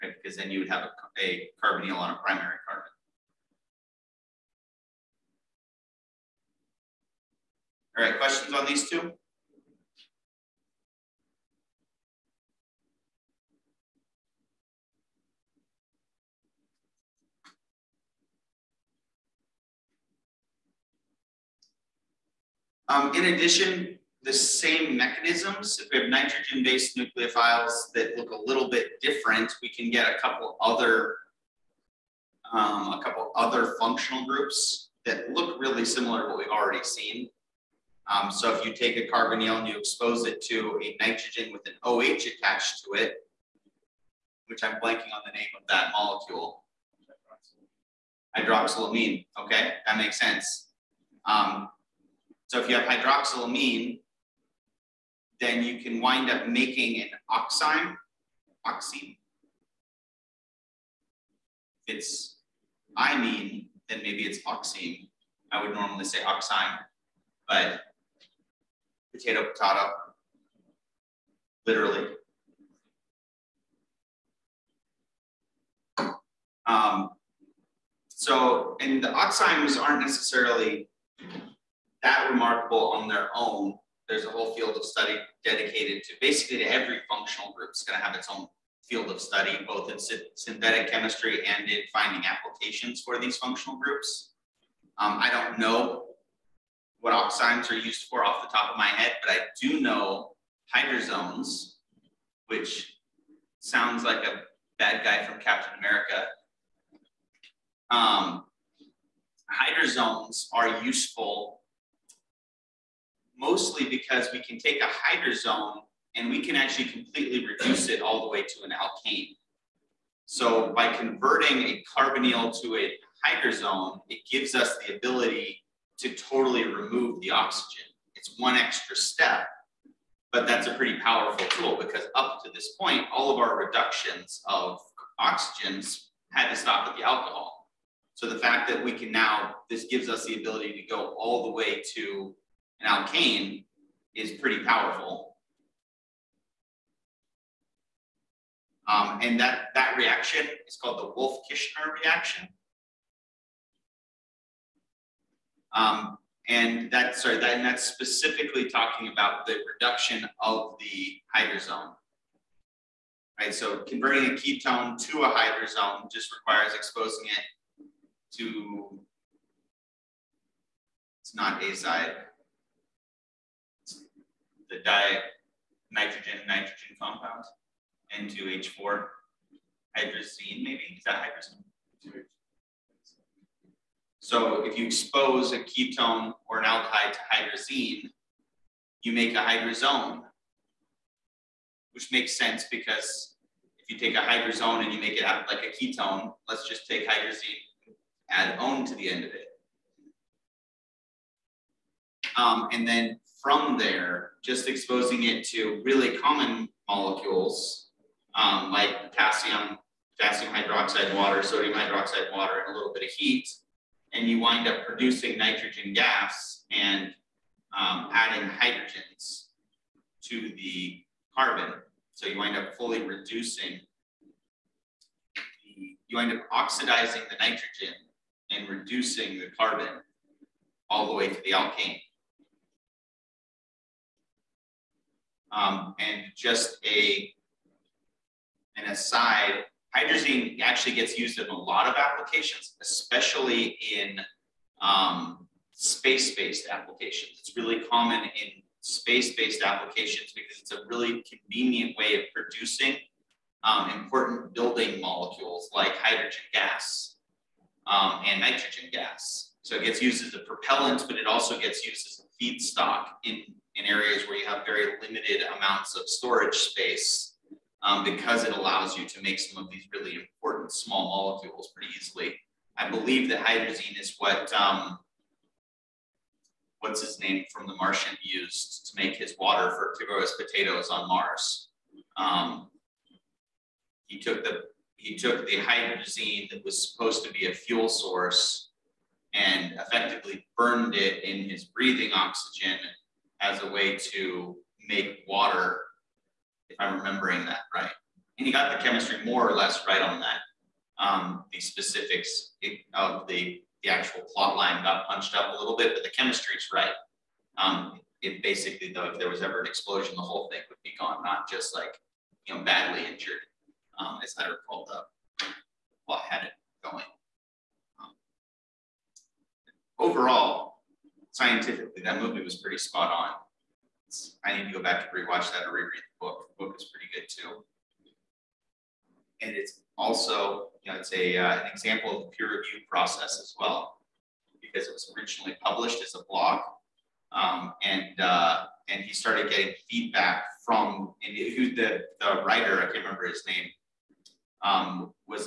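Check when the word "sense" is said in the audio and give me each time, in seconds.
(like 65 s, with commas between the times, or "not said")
50 s, 192 s.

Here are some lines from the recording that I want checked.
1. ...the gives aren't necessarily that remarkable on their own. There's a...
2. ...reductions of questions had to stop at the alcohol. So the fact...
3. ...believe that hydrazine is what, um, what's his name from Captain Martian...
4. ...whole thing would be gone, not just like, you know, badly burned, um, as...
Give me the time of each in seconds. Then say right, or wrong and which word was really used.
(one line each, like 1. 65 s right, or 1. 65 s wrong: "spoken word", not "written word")
1. 79 s wrong: "oximes", not "gives"
2. 133 s wrong: "oxygens", not "questions"
3. 272 s wrong: "The", not "Captain"
4. 310 s wrong: "injured", not "burned".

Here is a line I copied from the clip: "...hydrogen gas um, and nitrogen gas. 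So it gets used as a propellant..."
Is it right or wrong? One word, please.
right.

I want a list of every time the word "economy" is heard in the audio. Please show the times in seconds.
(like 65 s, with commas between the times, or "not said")
not said.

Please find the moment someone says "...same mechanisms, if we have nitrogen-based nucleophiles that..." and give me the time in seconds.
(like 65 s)
24 s.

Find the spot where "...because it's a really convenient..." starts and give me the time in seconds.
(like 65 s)
250 s.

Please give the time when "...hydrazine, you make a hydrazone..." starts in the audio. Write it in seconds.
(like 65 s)
187 s.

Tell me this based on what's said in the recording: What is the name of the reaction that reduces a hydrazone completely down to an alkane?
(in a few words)
Wolff-Kishner reaction.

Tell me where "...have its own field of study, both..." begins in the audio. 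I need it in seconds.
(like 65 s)
88 s.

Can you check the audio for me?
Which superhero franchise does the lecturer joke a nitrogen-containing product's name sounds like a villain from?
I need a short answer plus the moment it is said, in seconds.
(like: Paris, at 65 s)
Captain America, at 105 s.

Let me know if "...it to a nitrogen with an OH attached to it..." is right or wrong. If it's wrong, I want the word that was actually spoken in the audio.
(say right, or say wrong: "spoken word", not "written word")
right.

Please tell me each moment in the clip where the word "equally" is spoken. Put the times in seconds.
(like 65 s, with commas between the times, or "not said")
not said.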